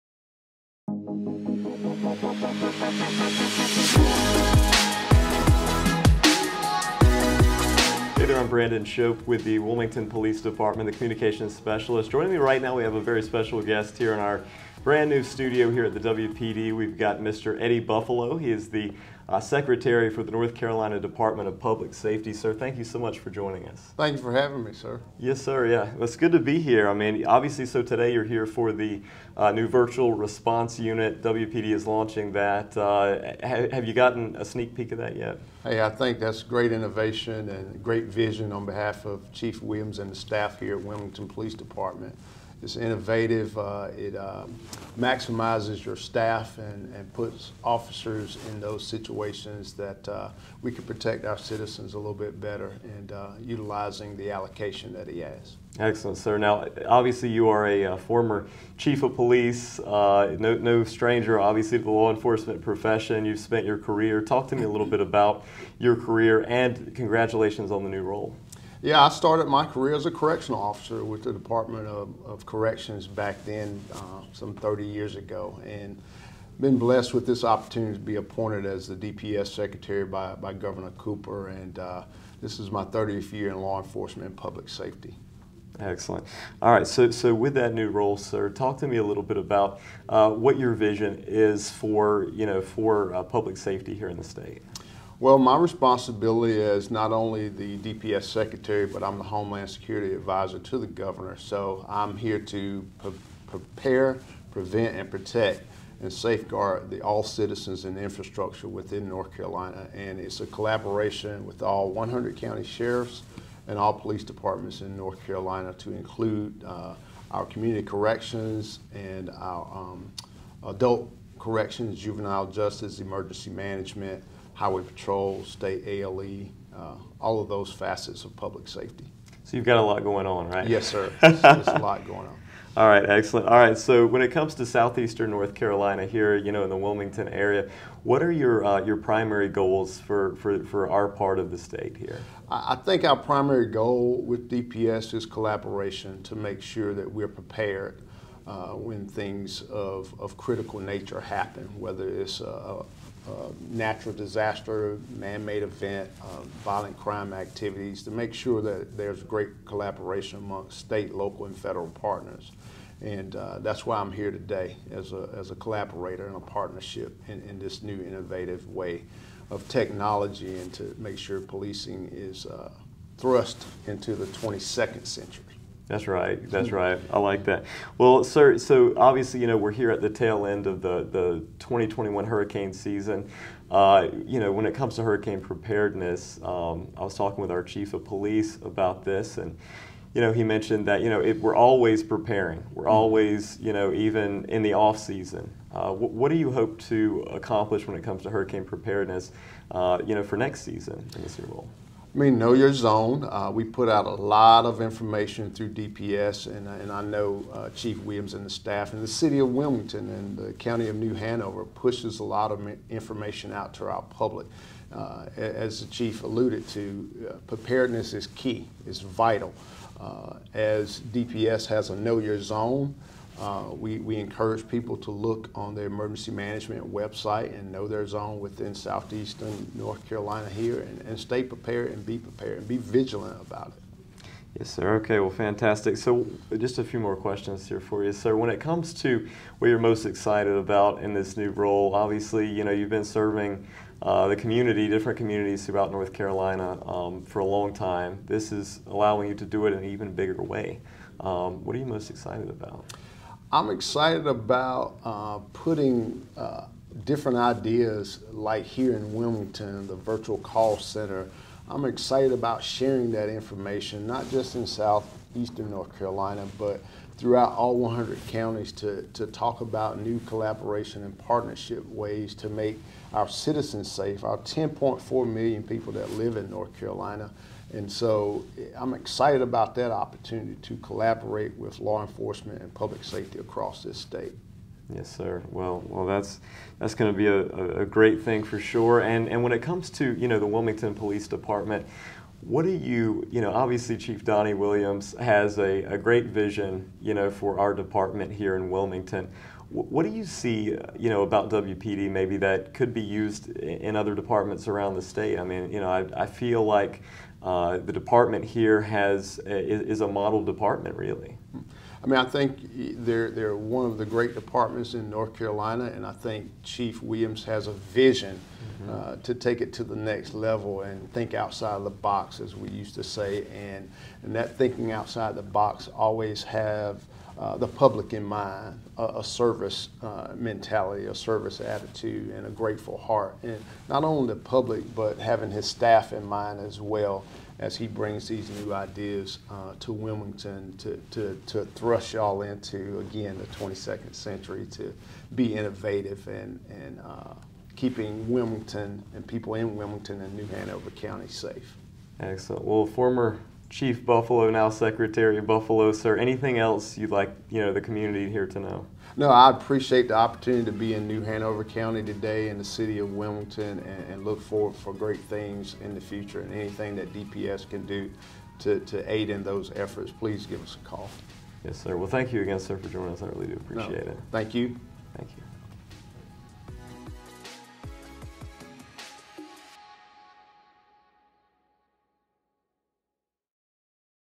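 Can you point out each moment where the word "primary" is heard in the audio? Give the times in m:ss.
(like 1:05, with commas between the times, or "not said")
2:18, 2:23.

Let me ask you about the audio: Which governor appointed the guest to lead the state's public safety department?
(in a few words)
Governor Cooper.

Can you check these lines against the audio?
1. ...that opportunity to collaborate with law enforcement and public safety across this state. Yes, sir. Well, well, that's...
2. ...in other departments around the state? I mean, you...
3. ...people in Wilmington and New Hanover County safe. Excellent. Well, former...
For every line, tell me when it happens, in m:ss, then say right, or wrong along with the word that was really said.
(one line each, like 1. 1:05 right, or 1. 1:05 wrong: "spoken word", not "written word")
1. 4:39 right
2. 5:03 right
3. 5:49 right.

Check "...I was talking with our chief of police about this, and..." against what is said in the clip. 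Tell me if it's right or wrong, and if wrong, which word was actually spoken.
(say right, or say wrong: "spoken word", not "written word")
right.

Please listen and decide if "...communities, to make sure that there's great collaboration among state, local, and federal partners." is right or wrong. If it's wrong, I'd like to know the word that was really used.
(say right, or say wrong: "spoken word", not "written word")
wrong: "activities", not "communities".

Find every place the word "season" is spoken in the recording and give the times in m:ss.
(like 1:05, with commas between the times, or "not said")
3:02, 3:14, 3:20.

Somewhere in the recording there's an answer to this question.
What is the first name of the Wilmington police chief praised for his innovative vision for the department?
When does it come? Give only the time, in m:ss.
4:54.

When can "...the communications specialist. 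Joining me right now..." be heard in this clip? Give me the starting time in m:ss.
0:10.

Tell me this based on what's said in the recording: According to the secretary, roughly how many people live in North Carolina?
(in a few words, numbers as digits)
10.4 million.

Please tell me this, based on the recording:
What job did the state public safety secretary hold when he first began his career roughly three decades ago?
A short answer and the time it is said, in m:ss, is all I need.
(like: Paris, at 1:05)
Correctional officer, at 1:10.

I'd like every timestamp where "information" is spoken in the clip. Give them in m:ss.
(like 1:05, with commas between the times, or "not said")
3:24, 3:32, 4:23.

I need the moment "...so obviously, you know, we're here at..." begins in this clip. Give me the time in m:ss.
2:58.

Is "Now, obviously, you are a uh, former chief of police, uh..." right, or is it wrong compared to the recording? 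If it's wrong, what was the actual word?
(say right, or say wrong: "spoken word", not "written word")
right.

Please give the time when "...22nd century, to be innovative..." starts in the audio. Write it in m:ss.
5:43.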